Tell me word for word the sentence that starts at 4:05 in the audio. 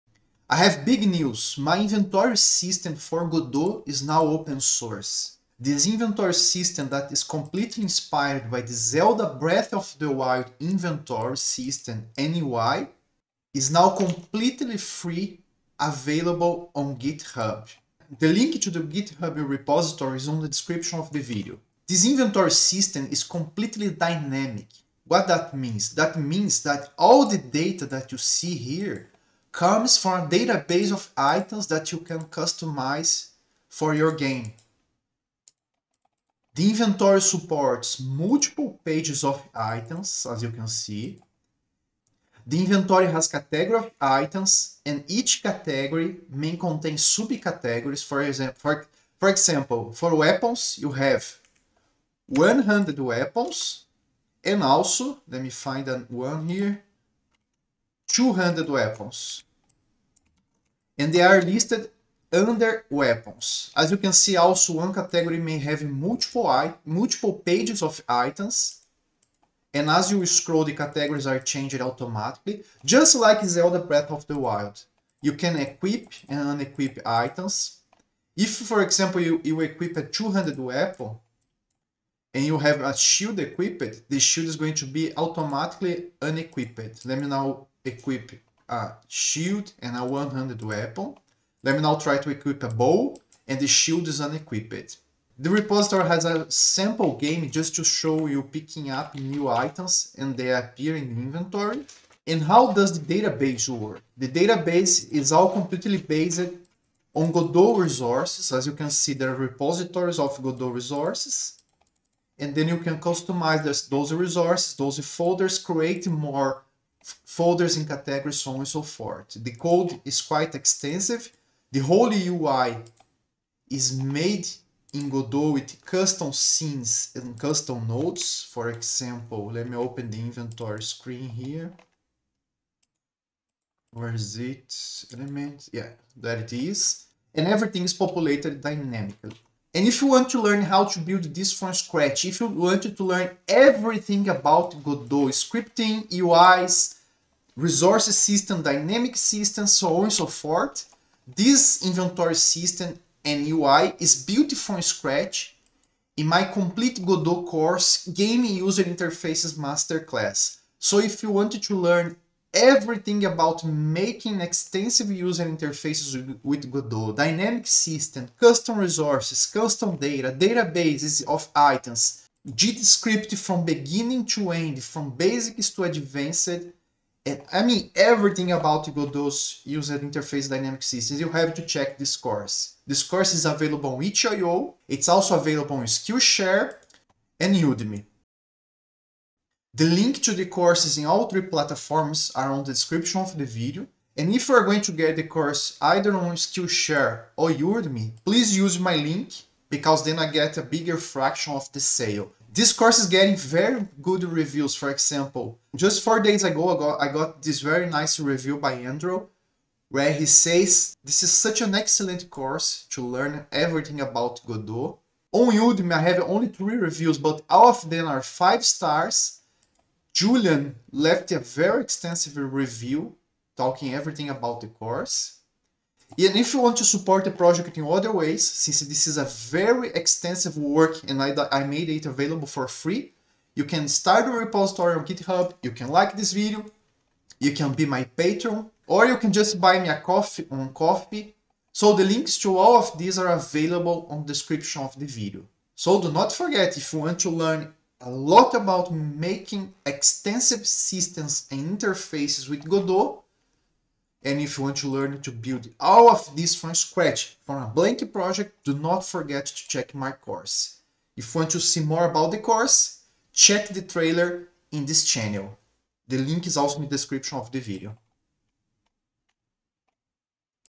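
So do not forget, if you want to learn a lot about making extensive systems and interfaces with Godot.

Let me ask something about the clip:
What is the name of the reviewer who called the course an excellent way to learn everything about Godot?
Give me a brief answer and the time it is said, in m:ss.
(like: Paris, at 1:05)
Andrew, at 3:28.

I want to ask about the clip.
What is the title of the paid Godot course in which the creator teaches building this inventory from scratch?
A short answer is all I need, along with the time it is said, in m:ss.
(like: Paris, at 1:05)
Game User Interfaces Masterclass, at 2:38.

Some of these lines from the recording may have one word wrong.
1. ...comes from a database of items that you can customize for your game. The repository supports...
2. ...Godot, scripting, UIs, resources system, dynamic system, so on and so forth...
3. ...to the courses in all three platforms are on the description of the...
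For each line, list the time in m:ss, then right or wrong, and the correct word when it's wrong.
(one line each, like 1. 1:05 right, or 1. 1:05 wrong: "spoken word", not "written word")
1. 0:29 wrong: "inventory", not "repository"
2. 2:24 right
3. 3:10 right.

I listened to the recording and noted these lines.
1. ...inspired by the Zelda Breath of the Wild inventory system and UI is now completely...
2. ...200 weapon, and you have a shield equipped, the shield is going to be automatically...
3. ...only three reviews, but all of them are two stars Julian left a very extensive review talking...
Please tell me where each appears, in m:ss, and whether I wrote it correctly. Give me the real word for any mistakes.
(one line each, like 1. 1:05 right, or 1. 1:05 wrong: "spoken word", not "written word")
1. 0:07 right
2. 1:20 right
3. 3:36 wrong: "five", not "two".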